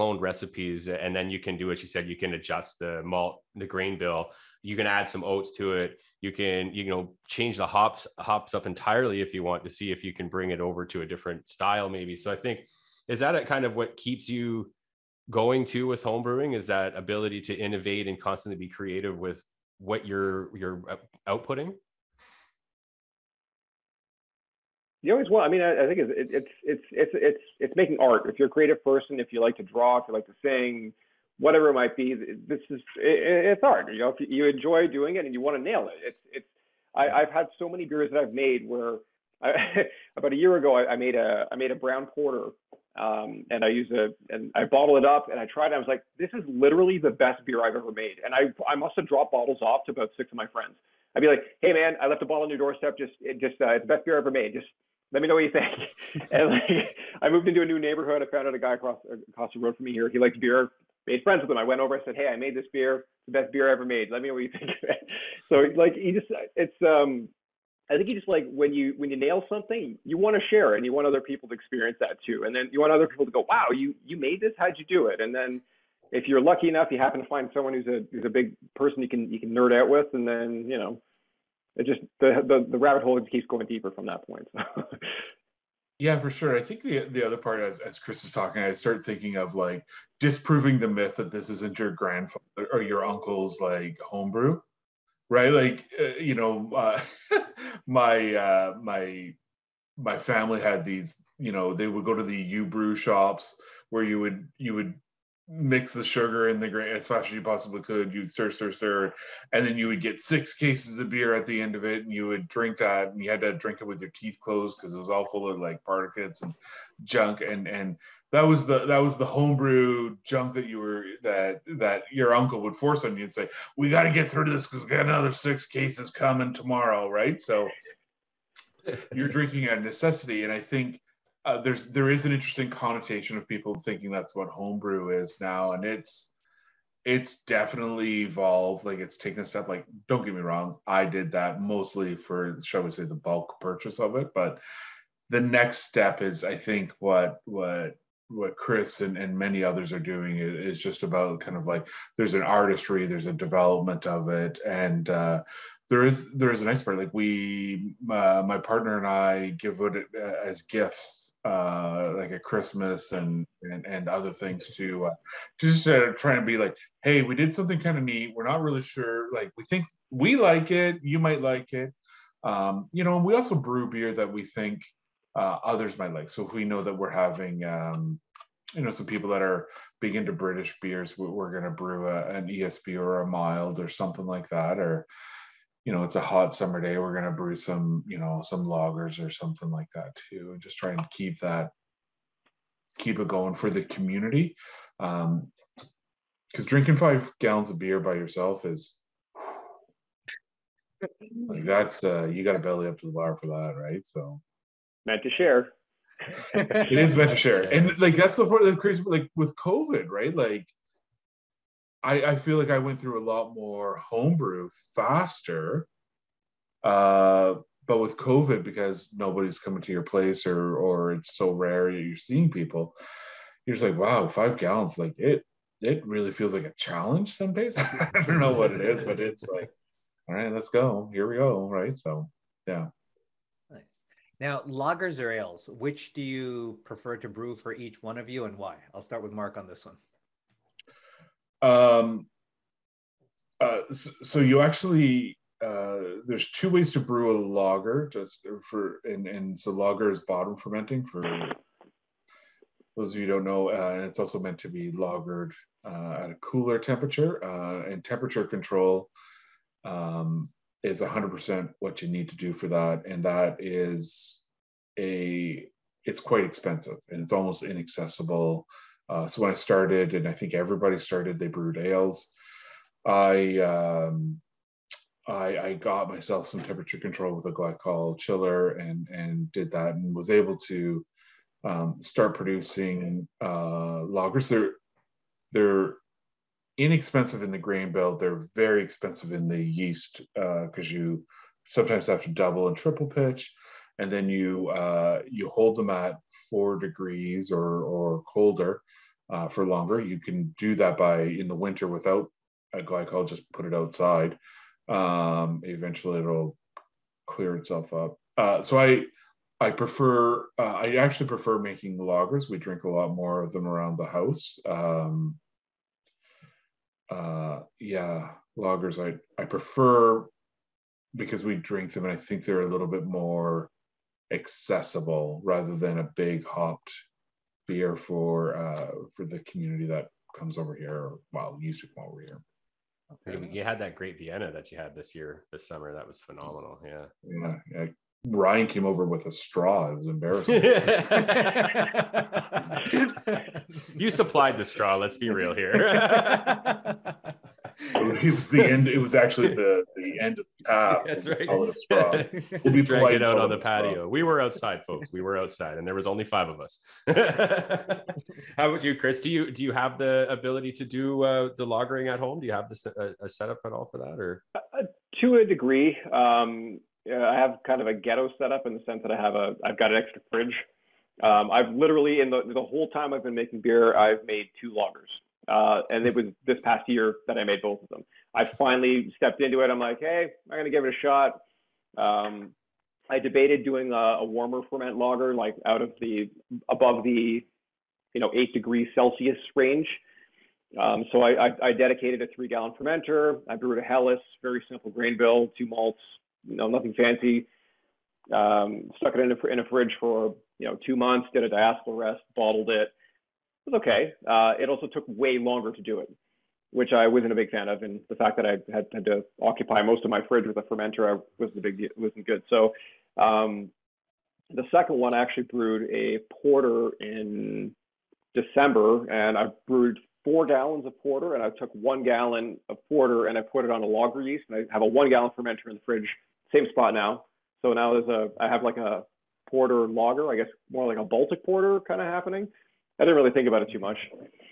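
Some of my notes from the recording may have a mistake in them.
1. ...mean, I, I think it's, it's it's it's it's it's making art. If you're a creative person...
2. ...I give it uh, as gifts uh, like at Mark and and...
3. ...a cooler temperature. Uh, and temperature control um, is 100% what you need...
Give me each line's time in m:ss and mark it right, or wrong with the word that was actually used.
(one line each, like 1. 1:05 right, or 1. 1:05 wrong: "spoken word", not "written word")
1. 0:25 right
2. 2:39 wrong: "Christmas", not "Mark"
3. 4:16 right.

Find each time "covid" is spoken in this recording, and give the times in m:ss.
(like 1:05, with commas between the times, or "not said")
3:29, 3:38.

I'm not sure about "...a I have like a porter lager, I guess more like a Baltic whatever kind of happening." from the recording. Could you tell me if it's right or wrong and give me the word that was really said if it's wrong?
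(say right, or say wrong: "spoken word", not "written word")
wrong: "porter", not "whatever".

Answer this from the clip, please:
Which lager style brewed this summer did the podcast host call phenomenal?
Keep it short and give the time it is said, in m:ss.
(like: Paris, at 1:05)
Vienna, at 5:34.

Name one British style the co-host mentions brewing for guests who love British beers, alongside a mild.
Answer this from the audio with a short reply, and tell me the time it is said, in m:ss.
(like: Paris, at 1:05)
ESB, at 3:02.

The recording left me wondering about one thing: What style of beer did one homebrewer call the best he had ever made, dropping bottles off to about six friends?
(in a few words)
Brown porter.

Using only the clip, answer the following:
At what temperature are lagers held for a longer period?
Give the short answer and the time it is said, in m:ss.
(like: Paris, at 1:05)
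4 degrees, at 4:56.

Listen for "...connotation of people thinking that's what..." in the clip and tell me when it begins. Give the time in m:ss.
2:12.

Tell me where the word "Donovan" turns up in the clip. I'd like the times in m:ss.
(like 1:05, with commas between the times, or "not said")
not said.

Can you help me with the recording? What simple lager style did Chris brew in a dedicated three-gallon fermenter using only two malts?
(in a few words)
Helles.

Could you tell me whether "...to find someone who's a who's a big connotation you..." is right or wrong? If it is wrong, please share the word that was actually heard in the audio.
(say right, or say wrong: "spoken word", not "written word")
wrong: "person", not "connotation".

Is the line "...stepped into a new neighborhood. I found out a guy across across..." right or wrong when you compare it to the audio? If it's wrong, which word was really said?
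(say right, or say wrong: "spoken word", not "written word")
wrong: "moved", not "stepped".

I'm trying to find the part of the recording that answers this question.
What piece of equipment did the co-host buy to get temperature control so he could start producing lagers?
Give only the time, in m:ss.
4:37.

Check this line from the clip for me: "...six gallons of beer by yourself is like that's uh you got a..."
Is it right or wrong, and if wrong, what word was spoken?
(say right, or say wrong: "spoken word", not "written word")
wrong: "five", not "six".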